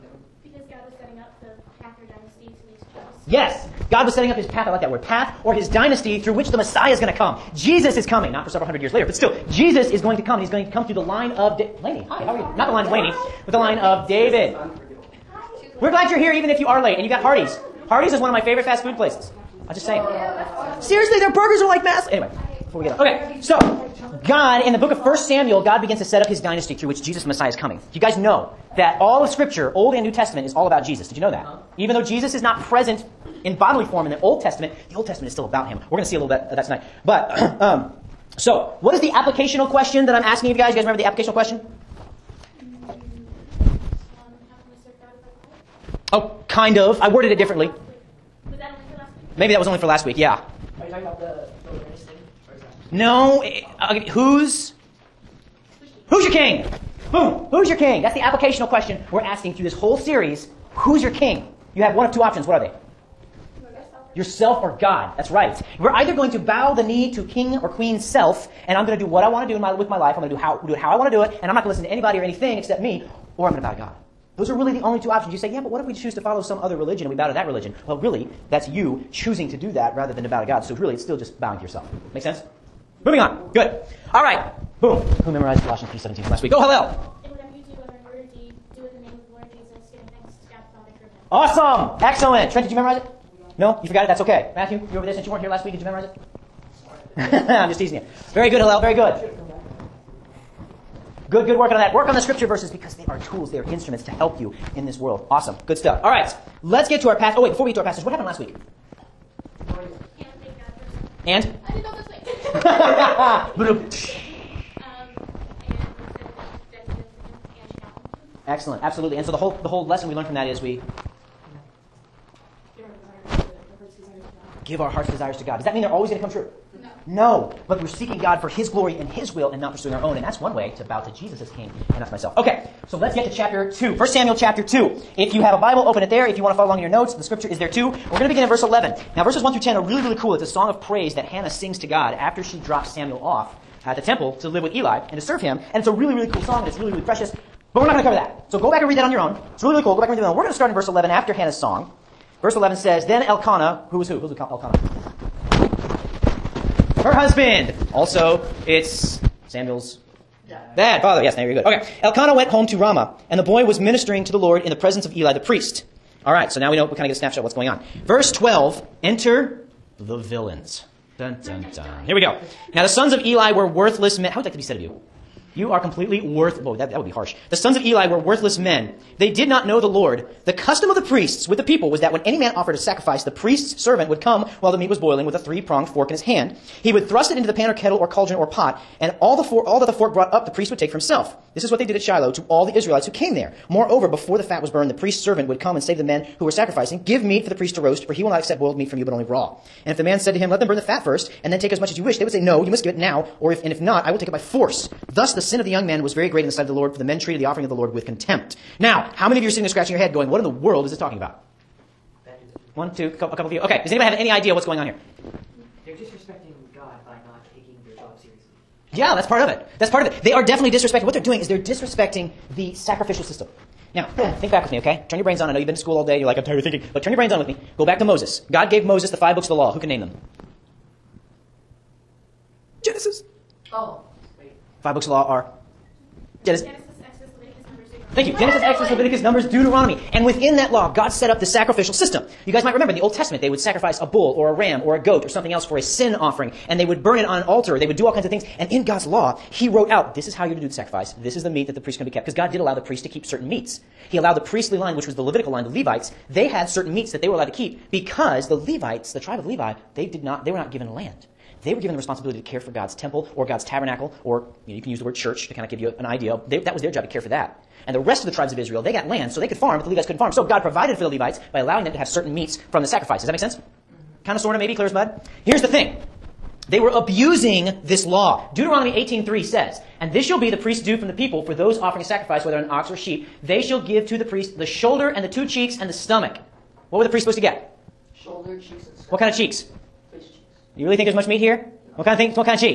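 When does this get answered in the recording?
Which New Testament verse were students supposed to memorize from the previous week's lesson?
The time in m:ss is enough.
1:25.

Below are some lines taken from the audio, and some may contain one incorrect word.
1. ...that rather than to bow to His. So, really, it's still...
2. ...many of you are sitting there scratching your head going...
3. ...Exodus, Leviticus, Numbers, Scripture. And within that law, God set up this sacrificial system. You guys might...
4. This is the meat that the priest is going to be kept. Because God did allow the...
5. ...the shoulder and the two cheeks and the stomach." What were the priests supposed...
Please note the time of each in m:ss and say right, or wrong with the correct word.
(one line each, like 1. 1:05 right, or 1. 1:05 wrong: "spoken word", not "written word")
1. 1:19 wrong: "God", not "His"
2. 3:29 right
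3. 3:58 wrong: "Deuteronomy", not "Scripture"
4. 4:11 right
5. 4:44 right.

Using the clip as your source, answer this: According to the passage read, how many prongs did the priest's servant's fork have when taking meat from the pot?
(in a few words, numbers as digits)
3.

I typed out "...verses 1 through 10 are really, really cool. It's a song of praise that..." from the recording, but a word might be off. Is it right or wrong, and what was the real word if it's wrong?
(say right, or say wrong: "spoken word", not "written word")
right.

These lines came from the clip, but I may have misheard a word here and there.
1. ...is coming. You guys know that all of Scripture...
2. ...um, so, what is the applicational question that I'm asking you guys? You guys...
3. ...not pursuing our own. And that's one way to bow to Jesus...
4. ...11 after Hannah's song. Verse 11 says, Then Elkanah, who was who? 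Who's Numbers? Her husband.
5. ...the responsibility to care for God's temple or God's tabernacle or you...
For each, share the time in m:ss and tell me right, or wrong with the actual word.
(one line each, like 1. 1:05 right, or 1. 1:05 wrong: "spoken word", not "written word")
1. 0:27 right
2. 0:37 right
3. 2:09 right
4. 2:30 wrong: "Elkanah", not "Numbers"
5. 4:21 right.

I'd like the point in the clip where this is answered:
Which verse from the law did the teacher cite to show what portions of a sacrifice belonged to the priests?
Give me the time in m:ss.
4:38.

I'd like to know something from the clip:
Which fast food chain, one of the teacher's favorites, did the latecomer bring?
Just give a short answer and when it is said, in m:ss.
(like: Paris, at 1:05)
Hardee's, at 0:17.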